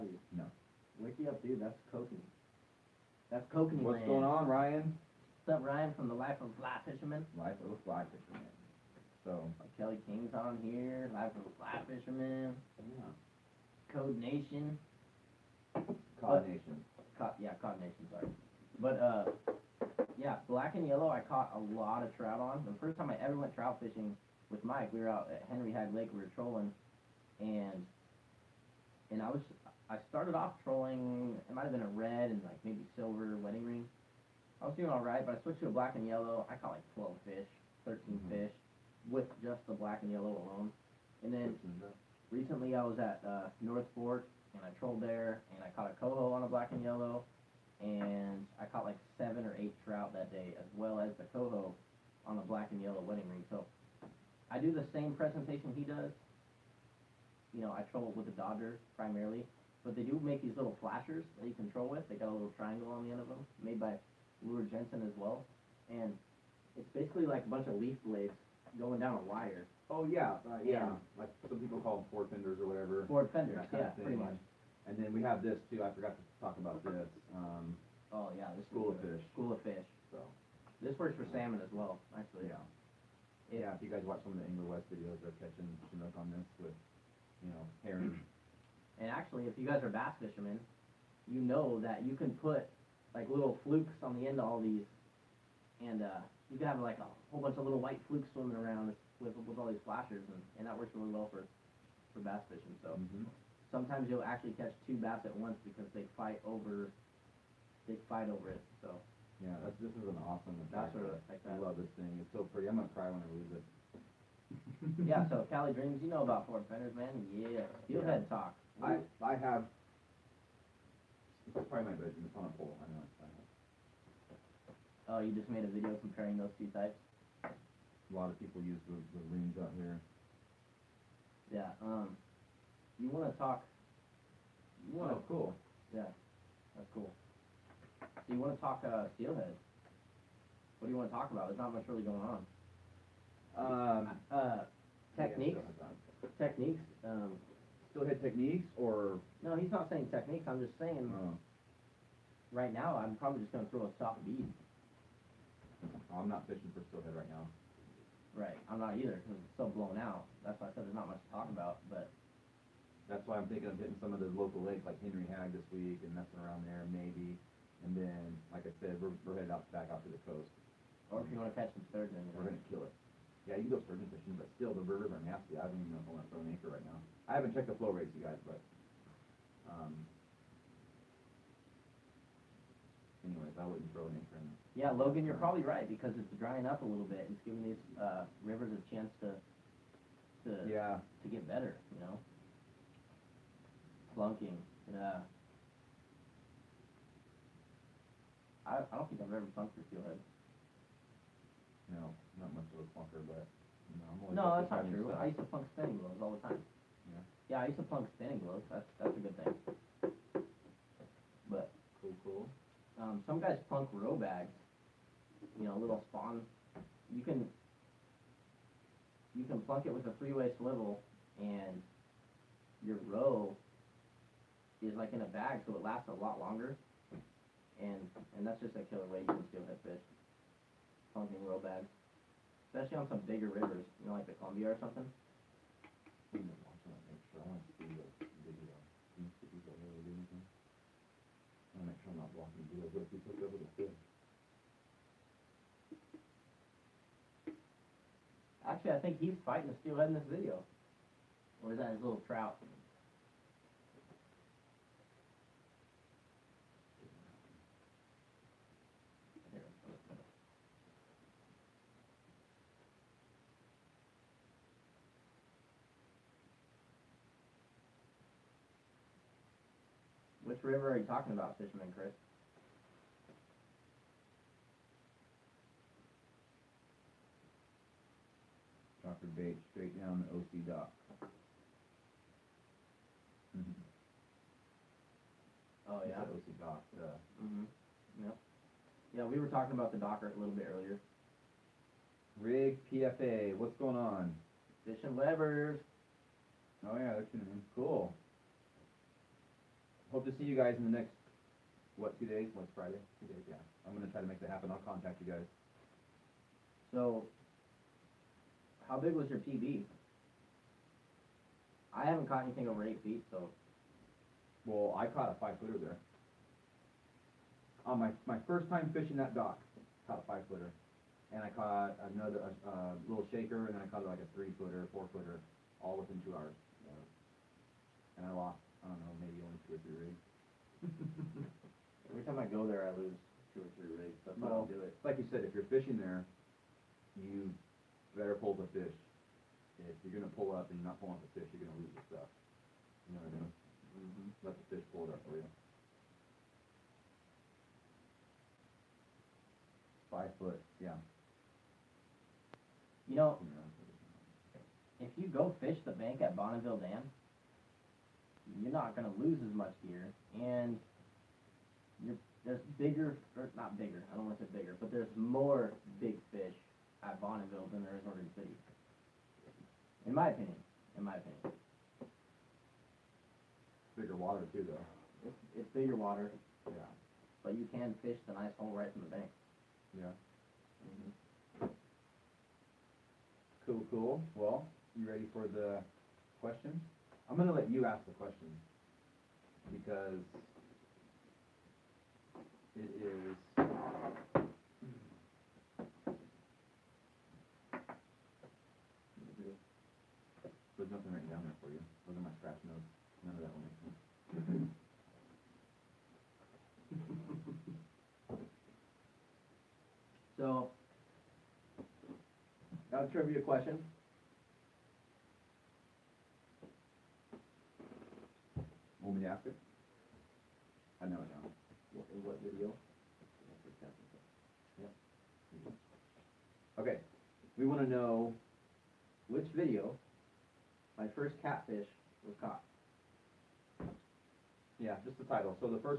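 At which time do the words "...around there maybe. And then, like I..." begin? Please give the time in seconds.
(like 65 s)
166 s.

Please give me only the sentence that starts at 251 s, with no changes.
Or is that his little trout?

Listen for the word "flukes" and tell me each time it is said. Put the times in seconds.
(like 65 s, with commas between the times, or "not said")
93 s, 98 s.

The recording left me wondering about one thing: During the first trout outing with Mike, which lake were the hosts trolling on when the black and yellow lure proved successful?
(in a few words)
Henry Hyde Lake.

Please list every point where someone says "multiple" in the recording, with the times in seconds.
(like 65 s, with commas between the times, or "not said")
not said.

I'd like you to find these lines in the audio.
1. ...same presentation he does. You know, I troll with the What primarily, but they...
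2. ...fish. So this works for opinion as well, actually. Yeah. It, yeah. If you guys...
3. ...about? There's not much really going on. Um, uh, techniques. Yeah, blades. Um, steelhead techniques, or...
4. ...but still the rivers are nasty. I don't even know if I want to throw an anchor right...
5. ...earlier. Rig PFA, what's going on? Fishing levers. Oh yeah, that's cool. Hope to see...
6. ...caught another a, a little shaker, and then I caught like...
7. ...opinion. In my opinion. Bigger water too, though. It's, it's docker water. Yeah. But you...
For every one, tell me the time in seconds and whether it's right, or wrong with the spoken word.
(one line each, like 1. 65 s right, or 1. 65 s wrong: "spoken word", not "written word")
1. 54 s wrong: "Dodger", not "What"
2. 79 s wrong: "salmon", not "opinion"
3. 141 s wrong: "techniques", not "blades"
4. 174 s right
5. 290 s right
6. 321 s right
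7. 370 s wrong: "bigger", not "docker".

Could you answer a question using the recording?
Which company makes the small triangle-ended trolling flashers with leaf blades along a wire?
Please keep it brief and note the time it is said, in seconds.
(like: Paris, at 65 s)
Luhr Jensen, at 64 s.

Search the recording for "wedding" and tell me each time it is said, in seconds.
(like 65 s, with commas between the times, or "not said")
33 s, 52 s.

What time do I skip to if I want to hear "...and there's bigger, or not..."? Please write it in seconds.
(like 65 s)
360 s.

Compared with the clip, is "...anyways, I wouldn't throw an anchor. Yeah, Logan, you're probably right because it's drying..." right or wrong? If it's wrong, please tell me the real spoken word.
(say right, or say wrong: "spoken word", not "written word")
right.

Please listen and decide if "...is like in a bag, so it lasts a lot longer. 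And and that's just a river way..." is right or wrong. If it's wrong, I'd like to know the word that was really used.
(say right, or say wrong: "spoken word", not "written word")
wrong: "killer", not "river".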